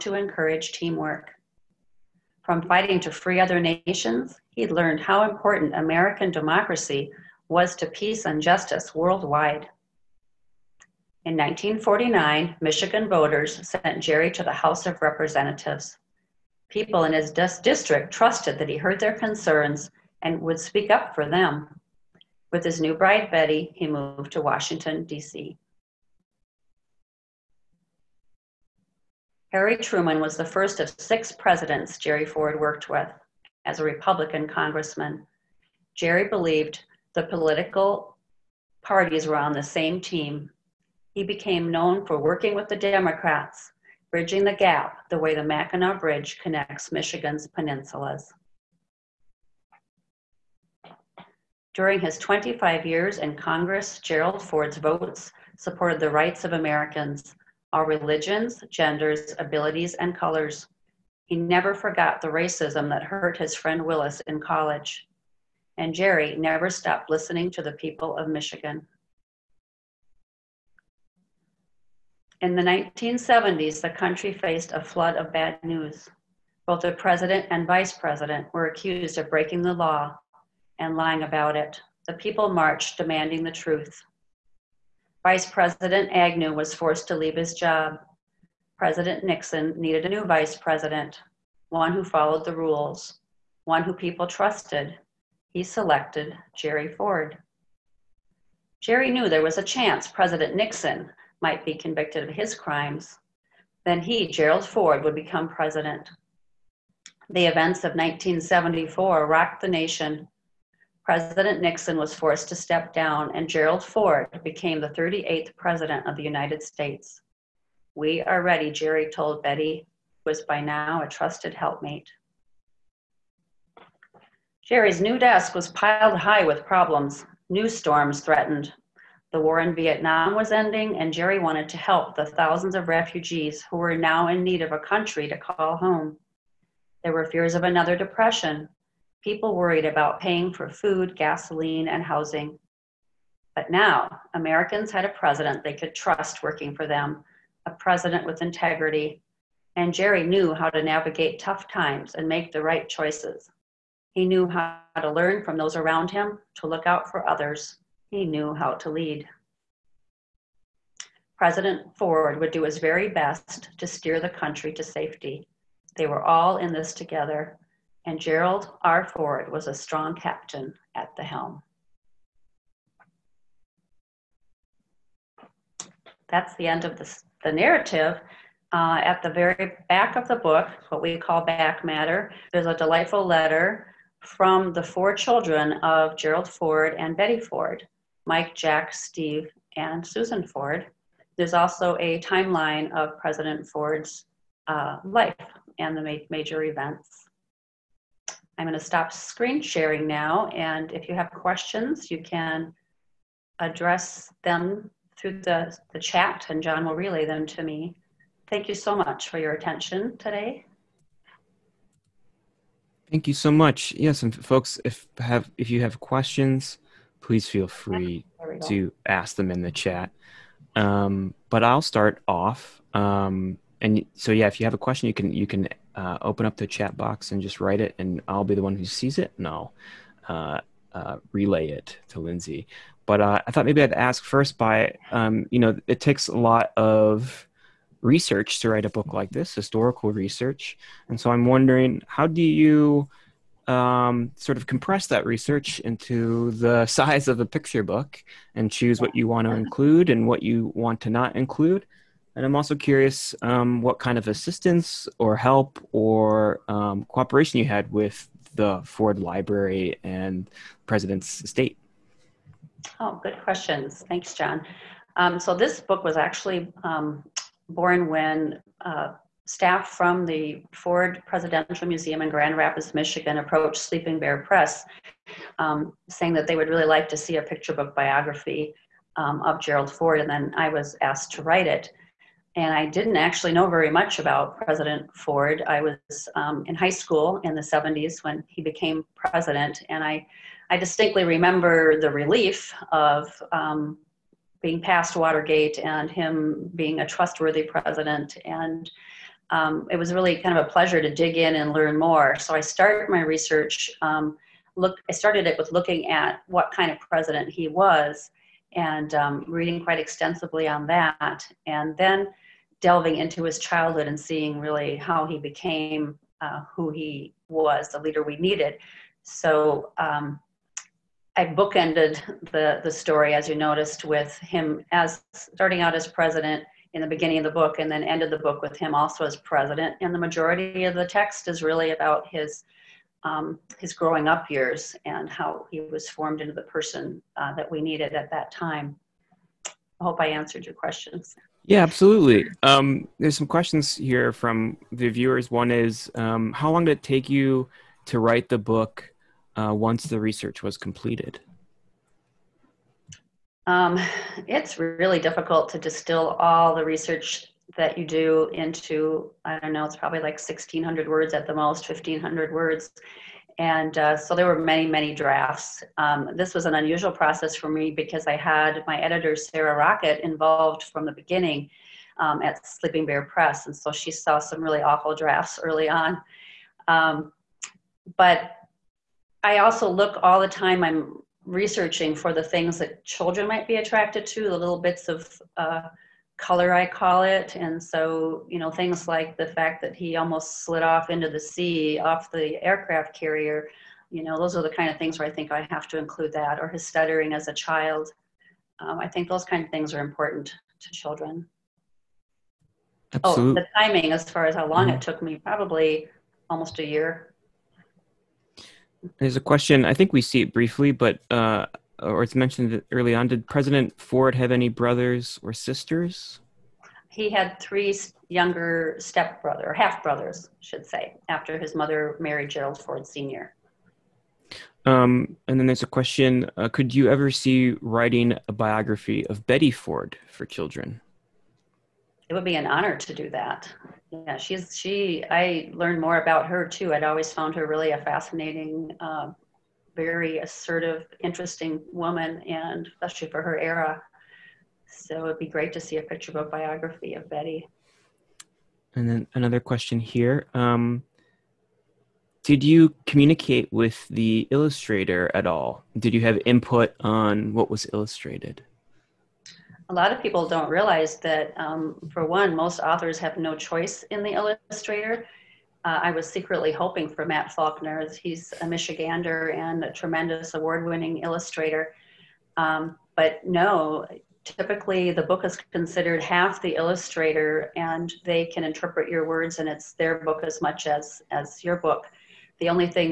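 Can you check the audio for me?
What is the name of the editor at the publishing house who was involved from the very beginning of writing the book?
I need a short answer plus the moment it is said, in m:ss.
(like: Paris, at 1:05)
Sarah Rockett, at 6:09.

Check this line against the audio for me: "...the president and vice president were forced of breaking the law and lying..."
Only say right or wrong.
wrong.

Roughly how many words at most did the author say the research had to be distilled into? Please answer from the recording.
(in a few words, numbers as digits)
1,600.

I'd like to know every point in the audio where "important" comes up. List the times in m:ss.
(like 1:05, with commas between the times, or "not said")
0:05, 6:39.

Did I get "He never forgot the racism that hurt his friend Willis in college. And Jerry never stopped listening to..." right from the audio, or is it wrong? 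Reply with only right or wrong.
right.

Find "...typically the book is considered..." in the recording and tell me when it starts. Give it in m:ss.
7:54.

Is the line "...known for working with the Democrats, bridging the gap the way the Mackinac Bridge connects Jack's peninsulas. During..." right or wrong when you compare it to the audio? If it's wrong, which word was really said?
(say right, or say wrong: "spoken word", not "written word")
wrong: "Michigan", not "Jack".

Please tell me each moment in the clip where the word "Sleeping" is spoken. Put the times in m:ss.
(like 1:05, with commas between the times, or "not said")
4:33, 6:12.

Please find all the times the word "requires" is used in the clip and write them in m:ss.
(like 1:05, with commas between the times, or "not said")
not said.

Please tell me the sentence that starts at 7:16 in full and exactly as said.
I'd always found her really a fascinating, uh, very assertive, interesting woman, and especially for her era.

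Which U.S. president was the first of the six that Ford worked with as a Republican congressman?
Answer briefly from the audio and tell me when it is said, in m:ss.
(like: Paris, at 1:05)
Harry Truman, at 0:29.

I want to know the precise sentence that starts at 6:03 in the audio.
And uh, so there were many, many drafts.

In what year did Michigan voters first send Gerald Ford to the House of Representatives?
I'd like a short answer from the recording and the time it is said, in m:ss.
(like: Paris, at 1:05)
1949, at 0:11.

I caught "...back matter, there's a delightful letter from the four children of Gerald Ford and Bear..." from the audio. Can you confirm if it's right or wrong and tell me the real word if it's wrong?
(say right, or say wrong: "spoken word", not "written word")
wrong: "Betty", not "Bear".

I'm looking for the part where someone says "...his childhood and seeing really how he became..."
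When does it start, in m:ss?
5:13.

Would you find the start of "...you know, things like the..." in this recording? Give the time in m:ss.
6:28.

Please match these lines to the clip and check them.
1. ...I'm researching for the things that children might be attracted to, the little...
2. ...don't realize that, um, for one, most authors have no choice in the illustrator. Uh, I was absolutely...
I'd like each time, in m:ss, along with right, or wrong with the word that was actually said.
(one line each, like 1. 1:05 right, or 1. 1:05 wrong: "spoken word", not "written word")
1. 6:20 right
2. 7:40 wrong: "secretly", not "absolutely".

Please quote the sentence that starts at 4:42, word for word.
And I didn't actually know very much about President Ford.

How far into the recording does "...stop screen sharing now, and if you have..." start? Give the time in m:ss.
3:18.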